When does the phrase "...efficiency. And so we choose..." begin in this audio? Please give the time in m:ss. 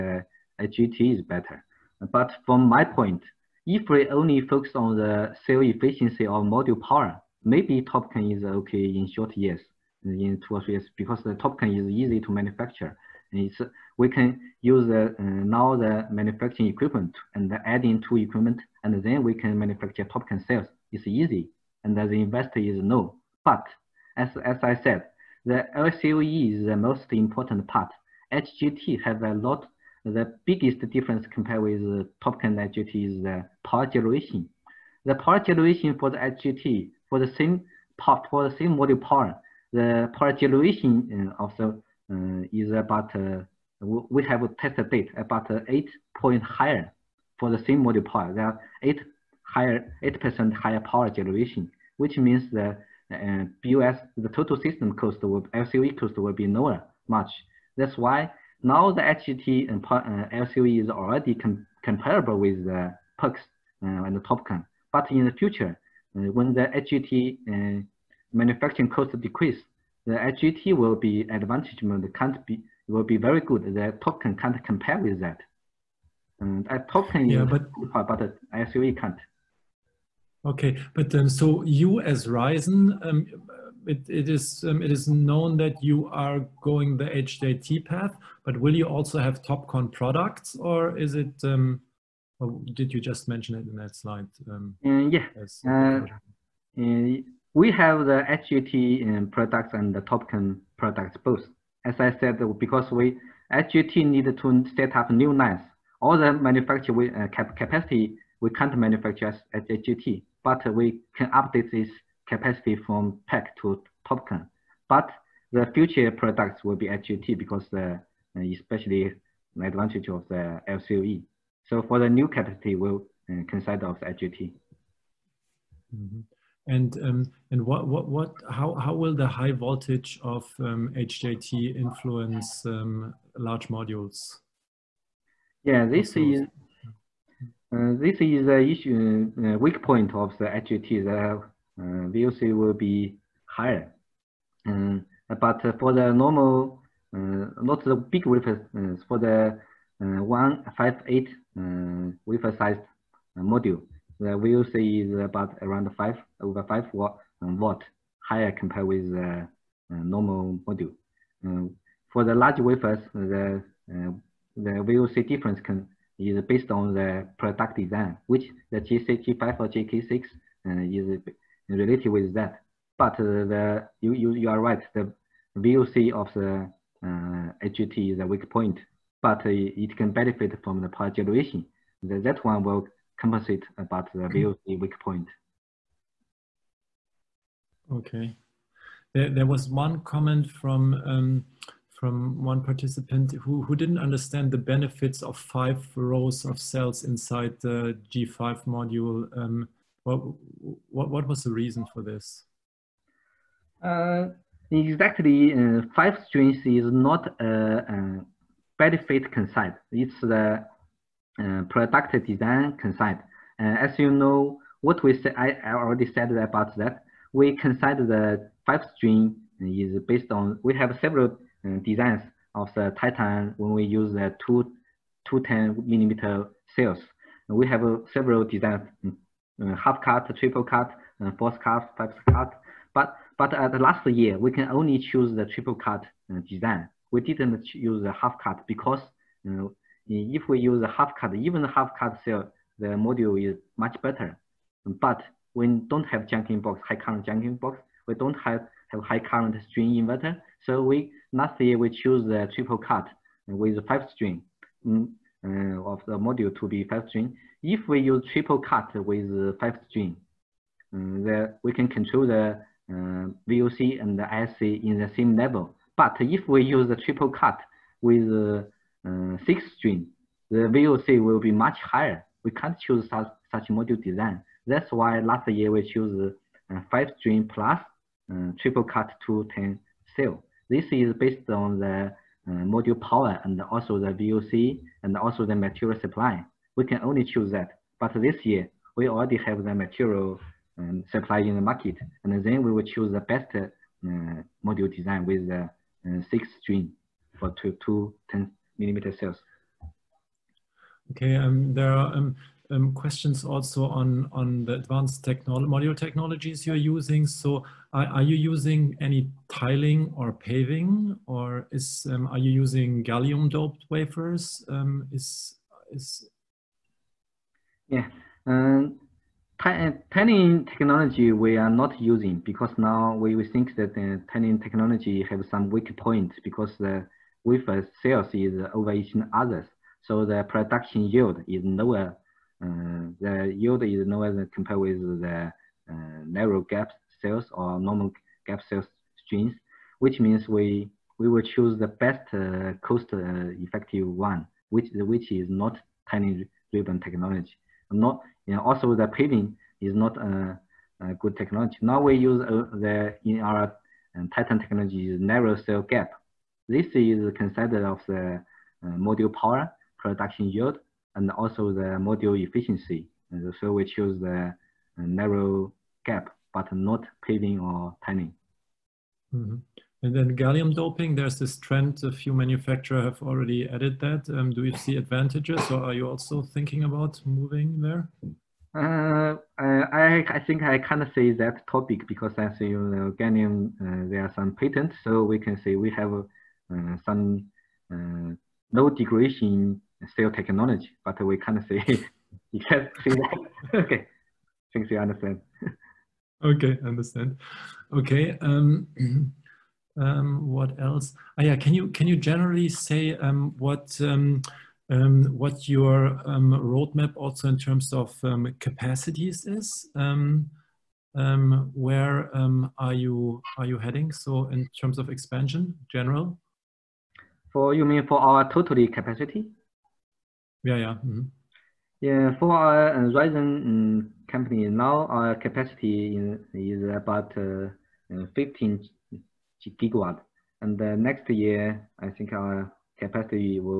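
6:02.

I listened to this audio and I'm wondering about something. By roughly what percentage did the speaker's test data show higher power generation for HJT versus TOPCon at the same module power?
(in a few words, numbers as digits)
8%.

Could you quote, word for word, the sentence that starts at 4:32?
We can't choose such, such module design.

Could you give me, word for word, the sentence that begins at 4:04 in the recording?
But we don't have junction box, high current junction box.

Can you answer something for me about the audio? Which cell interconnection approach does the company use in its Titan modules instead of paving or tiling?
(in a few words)
Narrow cell gap.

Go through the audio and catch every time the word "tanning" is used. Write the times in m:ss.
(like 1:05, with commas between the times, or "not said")
5:20, 5:24, 6:08.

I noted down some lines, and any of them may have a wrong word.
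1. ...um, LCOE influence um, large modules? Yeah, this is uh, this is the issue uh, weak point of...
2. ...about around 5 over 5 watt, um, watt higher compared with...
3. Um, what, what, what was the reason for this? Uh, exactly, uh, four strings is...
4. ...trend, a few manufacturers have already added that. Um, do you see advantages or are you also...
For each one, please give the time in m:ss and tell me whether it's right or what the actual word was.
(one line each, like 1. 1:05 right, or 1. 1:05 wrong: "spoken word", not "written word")
1. 2:10 wrong: "HJT", not "LCOE"
2. 2:35 right
3. 3:19 wrong: "five", not "four"
4. 6:11 right.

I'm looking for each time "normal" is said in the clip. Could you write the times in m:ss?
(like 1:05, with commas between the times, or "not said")
2:26, 2:39, 5:37.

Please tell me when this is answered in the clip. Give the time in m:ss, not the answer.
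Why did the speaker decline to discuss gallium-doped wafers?
6:24.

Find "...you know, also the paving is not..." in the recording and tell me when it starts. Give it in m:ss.
5:48.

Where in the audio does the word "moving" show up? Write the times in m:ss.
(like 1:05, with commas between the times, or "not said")
6:17.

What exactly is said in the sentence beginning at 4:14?
Mm, uh, of the module to be five string.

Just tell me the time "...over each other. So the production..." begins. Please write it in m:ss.
5:28.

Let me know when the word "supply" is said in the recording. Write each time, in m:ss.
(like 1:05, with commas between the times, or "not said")
4:46, 4:51.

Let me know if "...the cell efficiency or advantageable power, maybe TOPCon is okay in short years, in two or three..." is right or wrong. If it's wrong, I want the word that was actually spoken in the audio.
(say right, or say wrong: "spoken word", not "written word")
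wrong: "module", not "advantageable".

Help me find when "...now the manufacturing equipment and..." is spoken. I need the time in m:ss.
0:15.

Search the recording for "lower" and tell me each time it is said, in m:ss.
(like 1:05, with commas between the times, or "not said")
0:56, 5:31.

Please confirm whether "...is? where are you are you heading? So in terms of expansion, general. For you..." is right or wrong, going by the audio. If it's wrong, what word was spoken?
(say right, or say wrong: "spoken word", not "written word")
right.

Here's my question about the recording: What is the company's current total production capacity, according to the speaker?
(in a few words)
15 GW.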